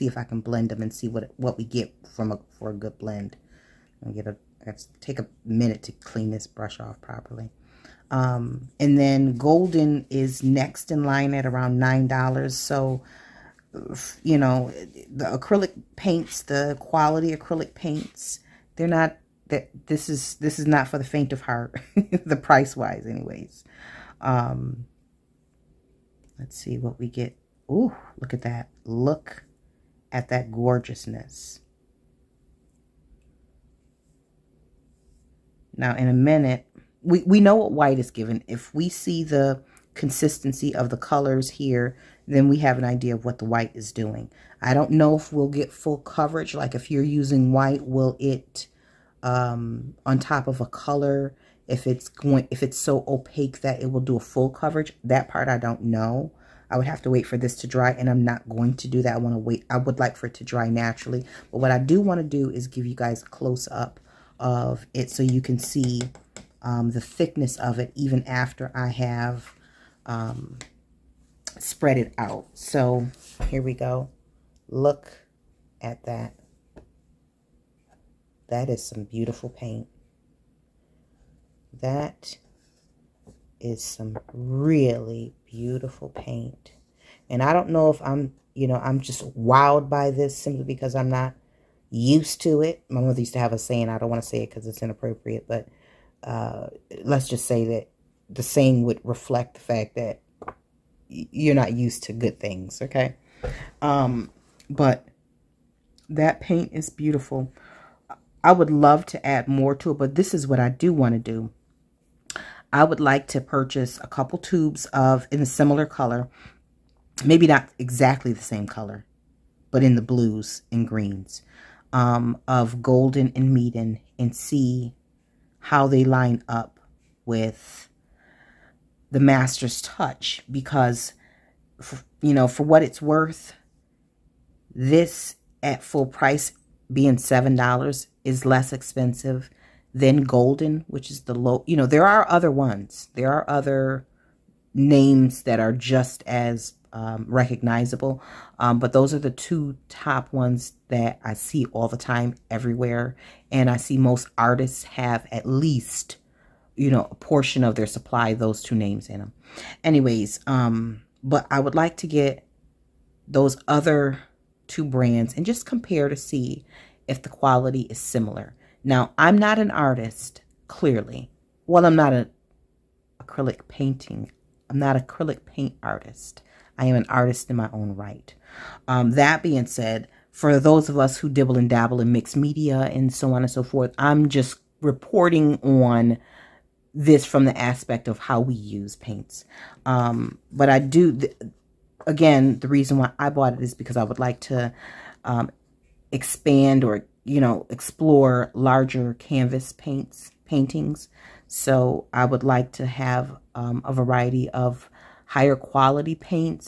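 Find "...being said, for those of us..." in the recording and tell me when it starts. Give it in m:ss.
2:59.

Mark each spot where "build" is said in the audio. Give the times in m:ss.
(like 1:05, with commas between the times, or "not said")
not said.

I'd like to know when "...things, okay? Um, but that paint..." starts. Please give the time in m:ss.
1:42.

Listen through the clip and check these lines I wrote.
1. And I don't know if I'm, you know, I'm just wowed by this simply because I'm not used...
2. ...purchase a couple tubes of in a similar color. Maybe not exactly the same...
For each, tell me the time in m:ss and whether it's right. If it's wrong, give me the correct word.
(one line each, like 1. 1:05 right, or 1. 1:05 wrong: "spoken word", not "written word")
1. 1:27 right
2. 1:53 right.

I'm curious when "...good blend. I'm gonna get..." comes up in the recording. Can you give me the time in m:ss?
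0:02.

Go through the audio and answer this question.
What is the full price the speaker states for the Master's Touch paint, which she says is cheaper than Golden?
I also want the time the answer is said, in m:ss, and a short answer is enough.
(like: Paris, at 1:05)
$7, at 2:17.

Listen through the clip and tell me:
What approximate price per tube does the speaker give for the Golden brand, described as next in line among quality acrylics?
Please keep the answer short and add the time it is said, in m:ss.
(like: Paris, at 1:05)
$9, at 0:11.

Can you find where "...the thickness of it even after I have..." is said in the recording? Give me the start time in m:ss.
1:06.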